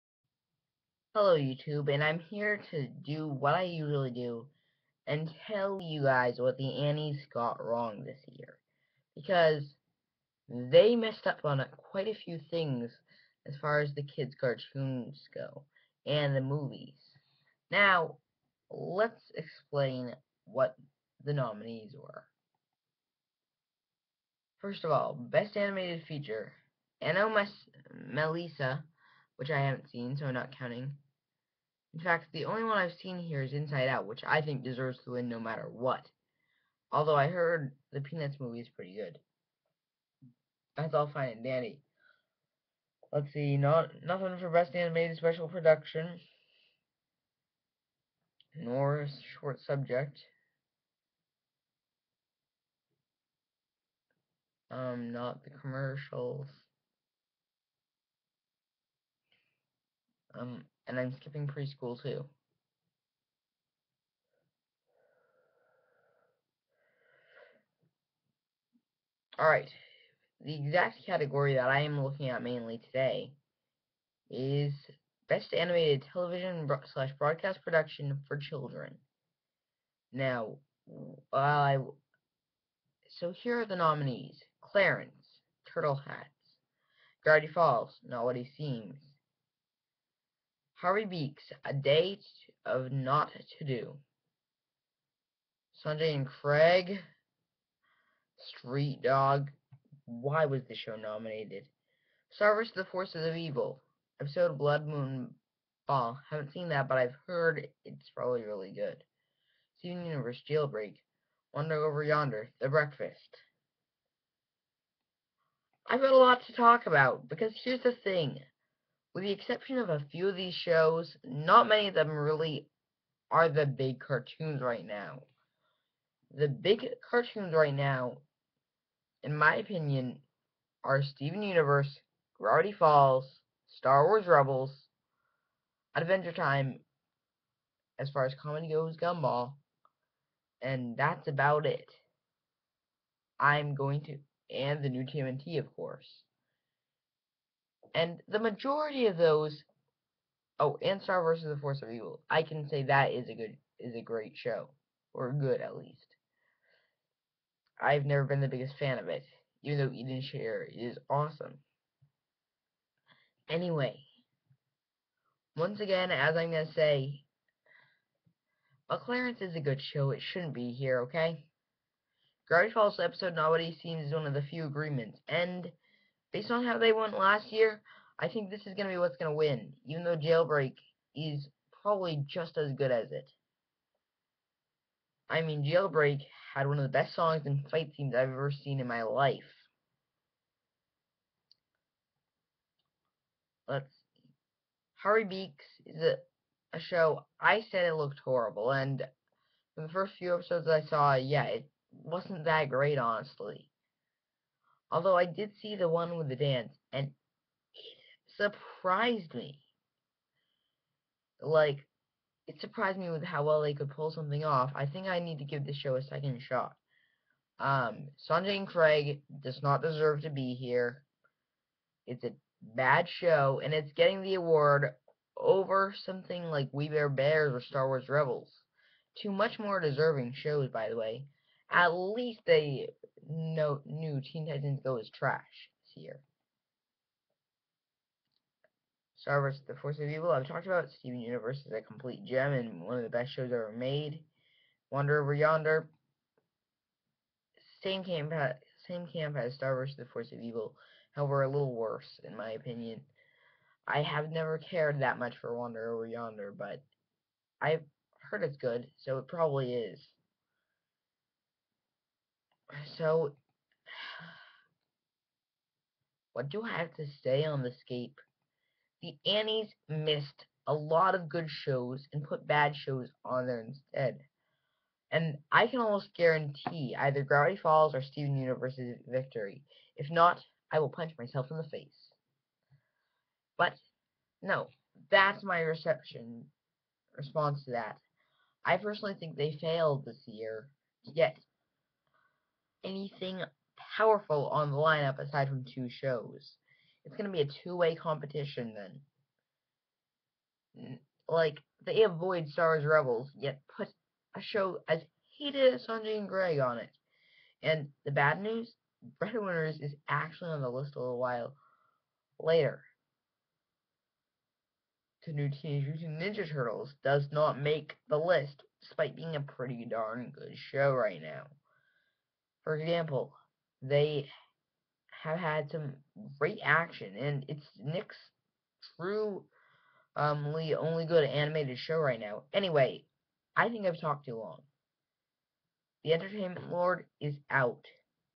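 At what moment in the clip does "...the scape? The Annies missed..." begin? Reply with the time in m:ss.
4:27.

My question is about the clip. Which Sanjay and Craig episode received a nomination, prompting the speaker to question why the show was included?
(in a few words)
Street Dog.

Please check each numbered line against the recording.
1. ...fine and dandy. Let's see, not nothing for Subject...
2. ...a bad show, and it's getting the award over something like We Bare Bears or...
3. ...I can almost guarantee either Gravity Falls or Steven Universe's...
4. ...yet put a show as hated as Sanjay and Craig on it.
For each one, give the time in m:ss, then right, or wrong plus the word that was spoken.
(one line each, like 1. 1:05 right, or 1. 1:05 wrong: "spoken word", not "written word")
1. 0:41 wrong: "Best", not "Subject"
2. 3:42 right
3. 4:35 right
4. 5:03 right.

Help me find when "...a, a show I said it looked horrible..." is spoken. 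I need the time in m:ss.
3:16.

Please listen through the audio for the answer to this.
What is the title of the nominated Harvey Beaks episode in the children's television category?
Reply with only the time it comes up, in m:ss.
1:31.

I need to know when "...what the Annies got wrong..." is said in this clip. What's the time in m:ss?
0:06.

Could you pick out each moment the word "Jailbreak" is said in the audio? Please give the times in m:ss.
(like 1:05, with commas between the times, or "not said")
1:50, 3:00, 3:05.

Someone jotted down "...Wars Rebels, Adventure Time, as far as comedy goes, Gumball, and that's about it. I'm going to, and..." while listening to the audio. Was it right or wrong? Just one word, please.
right.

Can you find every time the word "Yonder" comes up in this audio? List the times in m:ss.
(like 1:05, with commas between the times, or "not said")
1:52, 4:05, 4:16.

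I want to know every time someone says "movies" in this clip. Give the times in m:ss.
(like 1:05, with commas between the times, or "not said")
0:16, 0:38.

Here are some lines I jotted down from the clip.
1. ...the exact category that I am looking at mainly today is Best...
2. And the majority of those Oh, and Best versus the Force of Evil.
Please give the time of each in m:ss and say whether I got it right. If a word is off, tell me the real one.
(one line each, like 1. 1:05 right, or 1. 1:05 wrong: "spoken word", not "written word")
1. 1:10 right
2. 2:27 wrong: "Star", not "Best".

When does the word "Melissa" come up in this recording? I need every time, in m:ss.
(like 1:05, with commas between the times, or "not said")
0:28.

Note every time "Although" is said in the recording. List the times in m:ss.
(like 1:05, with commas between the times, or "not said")
0:36, 3:24.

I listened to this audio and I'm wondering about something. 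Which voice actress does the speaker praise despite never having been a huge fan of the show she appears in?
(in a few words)
Eden Sher.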